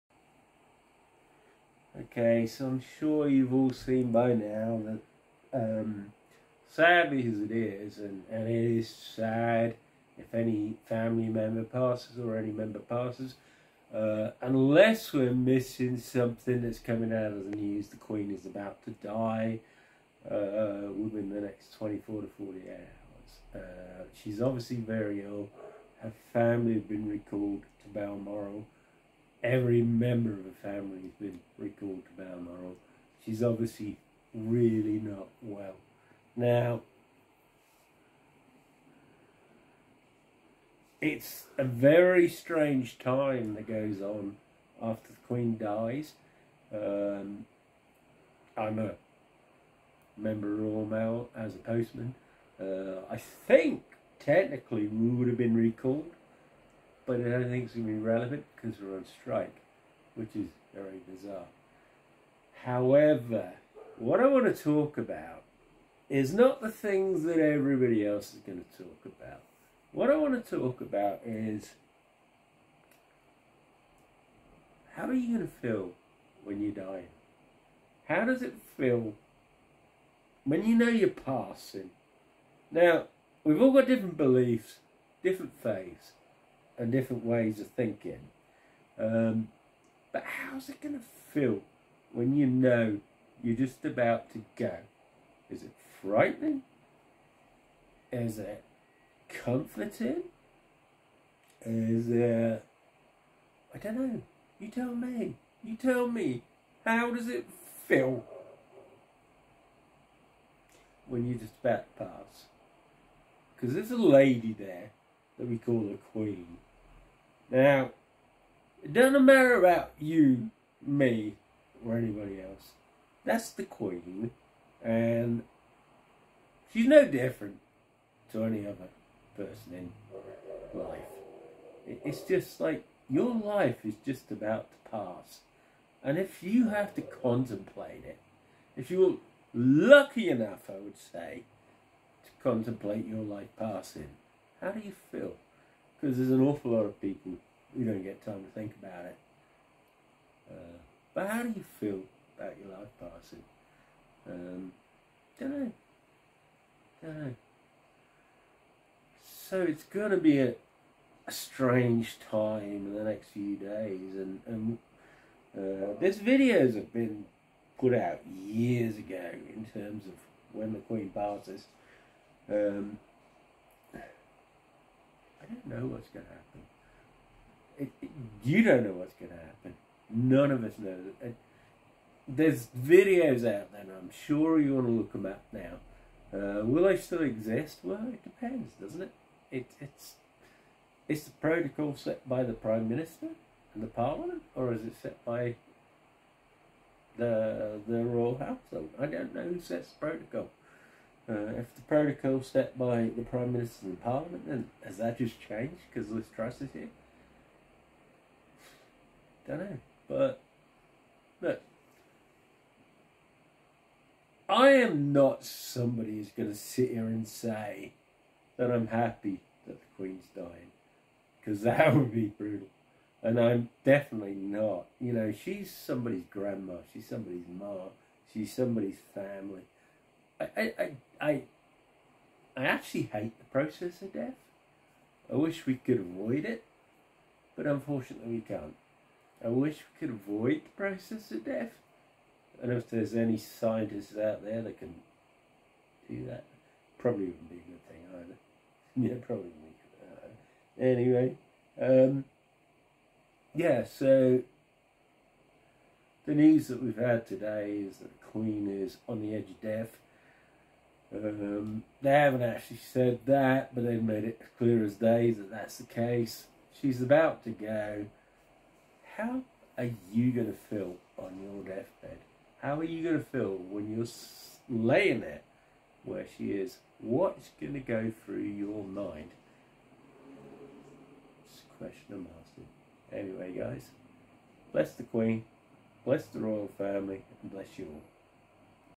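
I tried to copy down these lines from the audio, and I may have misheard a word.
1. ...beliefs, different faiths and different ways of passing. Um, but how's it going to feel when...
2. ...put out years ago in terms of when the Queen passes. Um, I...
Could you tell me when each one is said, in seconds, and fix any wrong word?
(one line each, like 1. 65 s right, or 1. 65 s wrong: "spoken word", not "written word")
1. 84 s wrong: "thinking", not "passing"
2. 167 s right.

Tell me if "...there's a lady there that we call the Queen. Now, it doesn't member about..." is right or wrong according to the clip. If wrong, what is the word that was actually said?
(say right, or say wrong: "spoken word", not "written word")
wrong: "matter", not "member".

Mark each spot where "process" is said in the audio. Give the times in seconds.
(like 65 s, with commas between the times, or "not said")
233 s, 240 s.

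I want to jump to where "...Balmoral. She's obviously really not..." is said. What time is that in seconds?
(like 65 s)
32 s.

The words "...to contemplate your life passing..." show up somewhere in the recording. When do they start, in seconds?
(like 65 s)
142 s.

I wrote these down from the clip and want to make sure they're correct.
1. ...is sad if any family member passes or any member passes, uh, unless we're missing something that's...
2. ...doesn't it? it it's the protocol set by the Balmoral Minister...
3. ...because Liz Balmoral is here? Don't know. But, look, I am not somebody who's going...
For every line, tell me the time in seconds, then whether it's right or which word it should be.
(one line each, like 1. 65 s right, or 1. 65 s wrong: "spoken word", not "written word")
1. 8 s right
2. 188 s wrong: "Prime", not "Balmoral"
3. 205 s wrong: "Truss", not "Balmoral".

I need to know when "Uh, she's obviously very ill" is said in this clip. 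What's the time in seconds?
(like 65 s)
23 s.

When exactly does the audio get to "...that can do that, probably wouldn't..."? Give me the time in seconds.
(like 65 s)
244 s.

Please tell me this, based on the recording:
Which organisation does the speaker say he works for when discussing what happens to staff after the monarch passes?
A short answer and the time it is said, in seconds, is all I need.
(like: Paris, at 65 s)
Royal Mail, at 50 s.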